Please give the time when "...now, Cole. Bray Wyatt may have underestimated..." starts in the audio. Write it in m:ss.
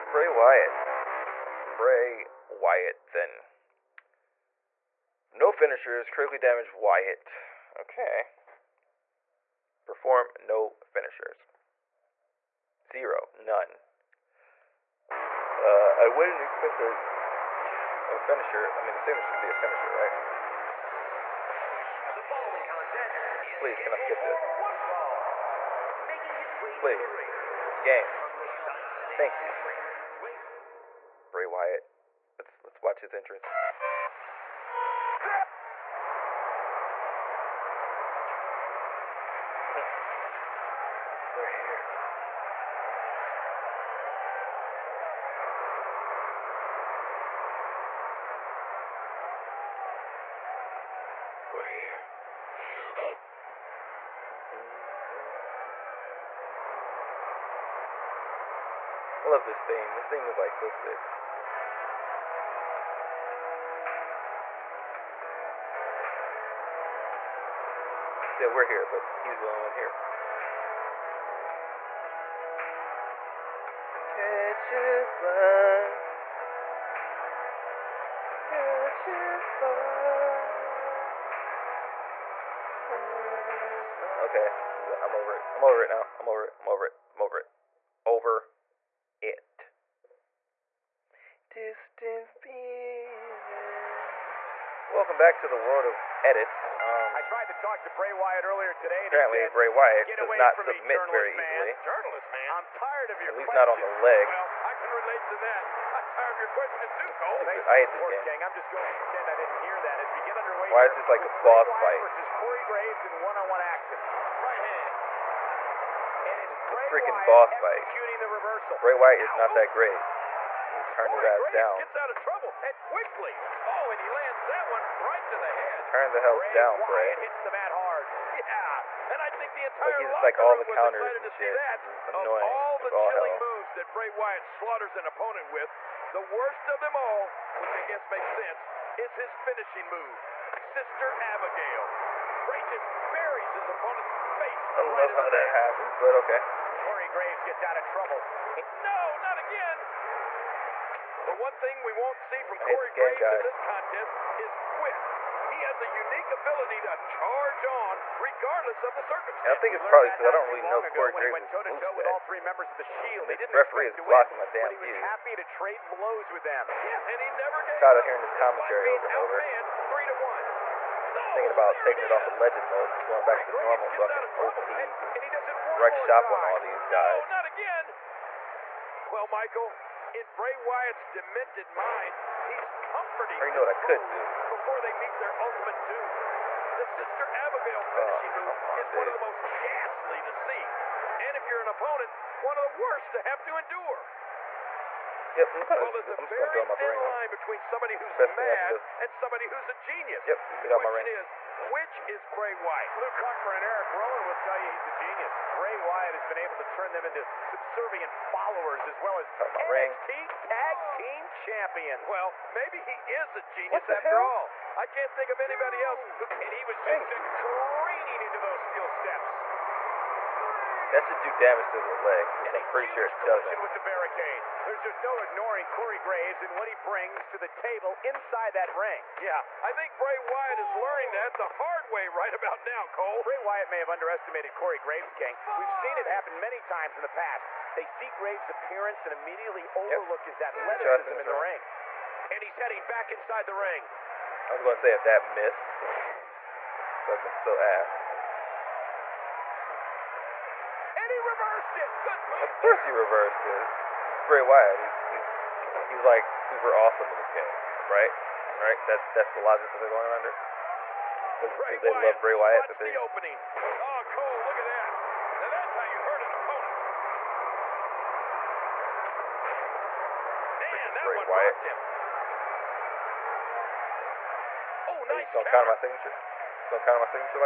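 3:52.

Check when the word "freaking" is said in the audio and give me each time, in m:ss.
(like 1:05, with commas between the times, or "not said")
1:56, 4:30.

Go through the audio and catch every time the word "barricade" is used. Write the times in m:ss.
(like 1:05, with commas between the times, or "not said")
3:43.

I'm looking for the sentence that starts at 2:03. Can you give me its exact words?
Oh, and he lands that one right to the head.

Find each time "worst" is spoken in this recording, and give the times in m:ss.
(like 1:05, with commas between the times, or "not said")
2:16, 3:12.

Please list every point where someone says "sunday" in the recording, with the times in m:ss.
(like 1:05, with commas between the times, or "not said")
not said.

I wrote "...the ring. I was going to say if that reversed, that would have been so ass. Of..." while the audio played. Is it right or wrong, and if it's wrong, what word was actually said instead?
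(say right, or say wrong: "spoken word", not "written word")
wrong: "missed", not "reversed".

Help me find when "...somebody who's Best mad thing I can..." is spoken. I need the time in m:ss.
3:17.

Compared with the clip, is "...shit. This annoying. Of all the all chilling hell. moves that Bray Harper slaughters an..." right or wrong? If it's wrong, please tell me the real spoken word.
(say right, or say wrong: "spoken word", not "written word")
wrong: "Wyatt", not "Harper".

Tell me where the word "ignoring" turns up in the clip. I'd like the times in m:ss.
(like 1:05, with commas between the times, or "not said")
3:45.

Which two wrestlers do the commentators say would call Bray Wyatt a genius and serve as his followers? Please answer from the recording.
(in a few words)
Luke Harper and Eric Rowan.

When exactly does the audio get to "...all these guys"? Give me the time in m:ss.
2:56.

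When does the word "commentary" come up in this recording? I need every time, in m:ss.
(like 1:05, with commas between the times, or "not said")
2:48.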